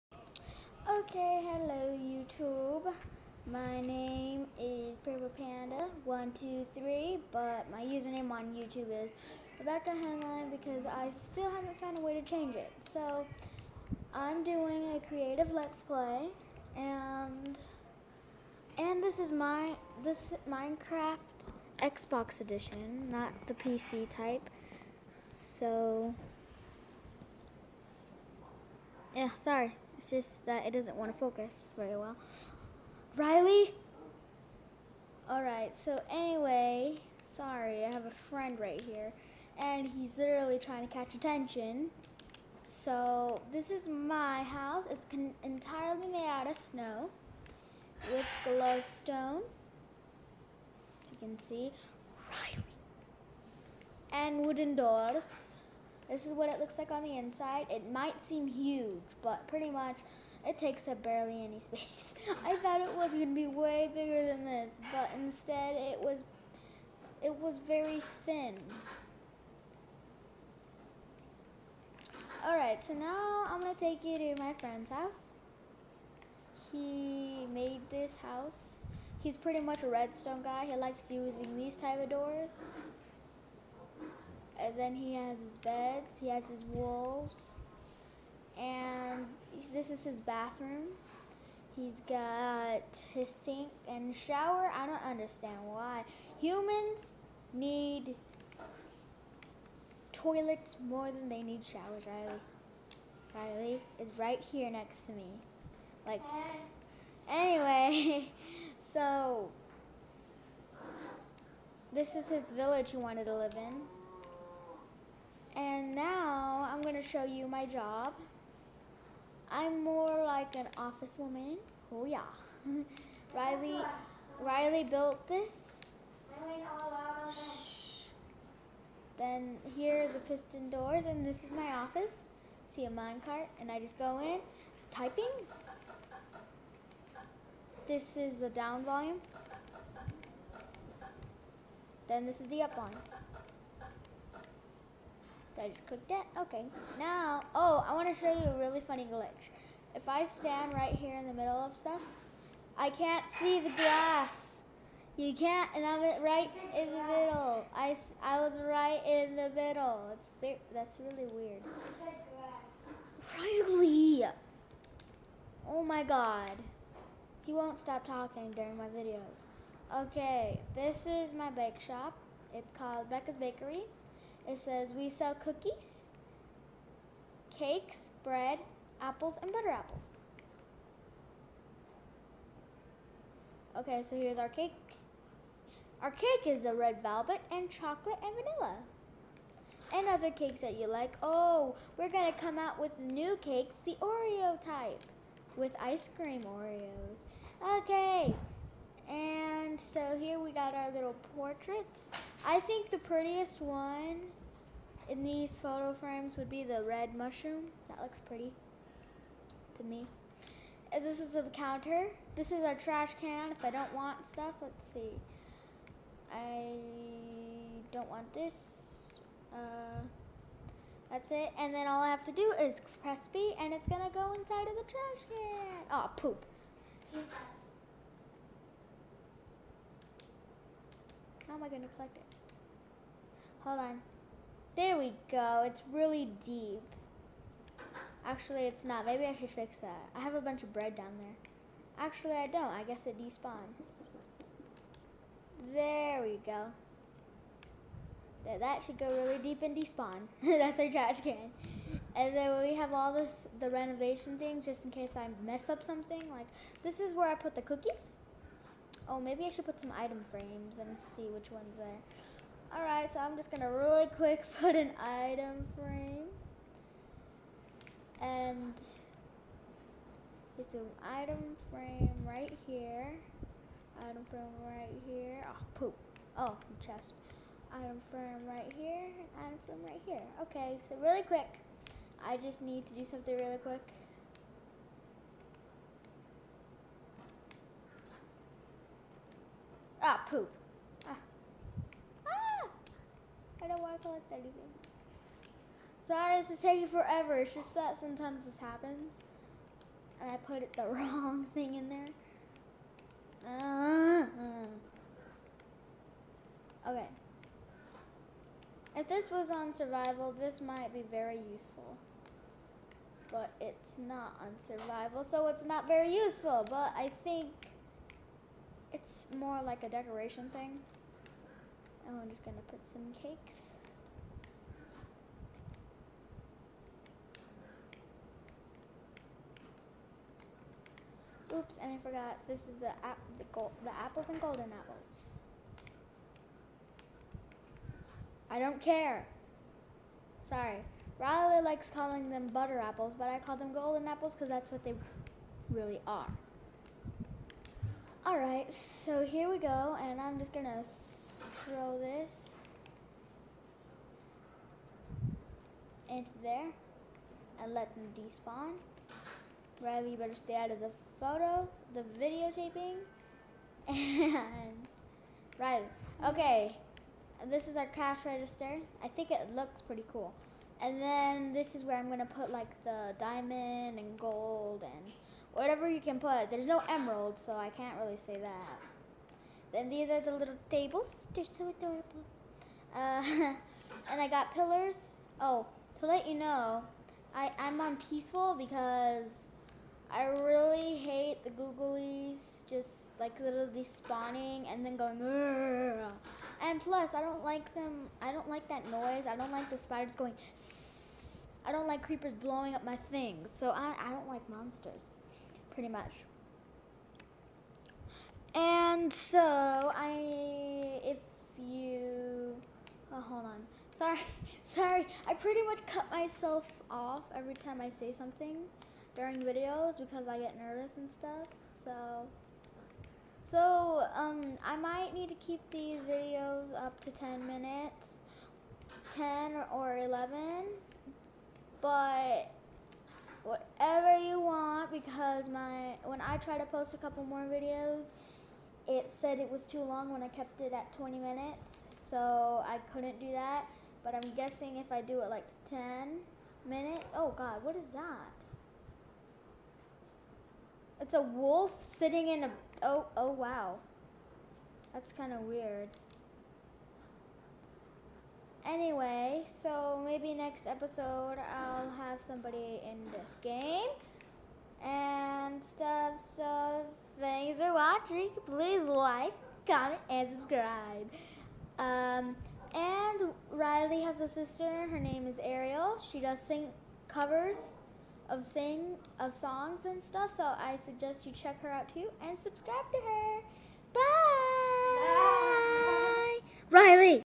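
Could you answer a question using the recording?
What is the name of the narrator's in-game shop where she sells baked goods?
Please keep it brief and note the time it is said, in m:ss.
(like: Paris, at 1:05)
Becca's Bakery, at 2:53.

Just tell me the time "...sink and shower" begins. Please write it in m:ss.
1:33.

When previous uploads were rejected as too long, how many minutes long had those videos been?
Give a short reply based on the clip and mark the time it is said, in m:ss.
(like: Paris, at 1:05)
20 minutes, at 7:20.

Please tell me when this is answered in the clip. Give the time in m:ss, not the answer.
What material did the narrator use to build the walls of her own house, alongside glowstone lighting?
0:46.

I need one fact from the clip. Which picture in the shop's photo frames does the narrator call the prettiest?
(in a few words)
Red mushroom.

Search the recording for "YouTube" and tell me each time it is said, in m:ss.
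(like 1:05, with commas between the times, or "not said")
0:01, 0:08.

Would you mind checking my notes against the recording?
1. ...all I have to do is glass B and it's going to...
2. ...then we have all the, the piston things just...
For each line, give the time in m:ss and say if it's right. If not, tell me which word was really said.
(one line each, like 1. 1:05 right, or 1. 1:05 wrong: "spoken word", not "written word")
1. 3:41 wrong: "press", not "glass"
2. 4:12 wrong: "renovation", not "piston".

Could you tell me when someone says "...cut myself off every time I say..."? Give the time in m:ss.
6:55.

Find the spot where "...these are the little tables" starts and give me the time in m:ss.
6:19.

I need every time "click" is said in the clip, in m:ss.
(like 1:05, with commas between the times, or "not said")
2:25.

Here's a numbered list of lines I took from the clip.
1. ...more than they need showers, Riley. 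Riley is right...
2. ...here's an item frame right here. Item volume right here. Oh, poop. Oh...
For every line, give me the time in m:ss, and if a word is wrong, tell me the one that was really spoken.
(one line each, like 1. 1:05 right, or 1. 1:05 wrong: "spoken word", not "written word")
1. 1:40 right
2. 4:30 wrong: "frame", not "volume".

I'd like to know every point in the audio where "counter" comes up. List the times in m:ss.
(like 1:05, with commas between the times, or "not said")
3:31.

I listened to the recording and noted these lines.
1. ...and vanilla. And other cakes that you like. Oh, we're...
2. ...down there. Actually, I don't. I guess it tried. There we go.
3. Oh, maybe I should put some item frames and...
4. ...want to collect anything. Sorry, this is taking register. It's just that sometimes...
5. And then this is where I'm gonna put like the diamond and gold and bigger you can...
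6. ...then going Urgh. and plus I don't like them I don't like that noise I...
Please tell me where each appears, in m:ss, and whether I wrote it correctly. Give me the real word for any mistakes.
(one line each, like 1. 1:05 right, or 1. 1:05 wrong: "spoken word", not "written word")
1. 3:08 right
2. 4:00 wrong: "despawned", not "tried"
3. 4:19 right
4. 4:53 wrong: "forever", not "register"
5. 6:10 wrong: "whatever", not "bigger"
6. 6:34 right.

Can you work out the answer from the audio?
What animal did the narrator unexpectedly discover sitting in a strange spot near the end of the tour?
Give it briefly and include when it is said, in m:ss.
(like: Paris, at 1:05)
A wolf, at 7:31.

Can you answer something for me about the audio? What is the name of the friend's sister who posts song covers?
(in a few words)
Ariel.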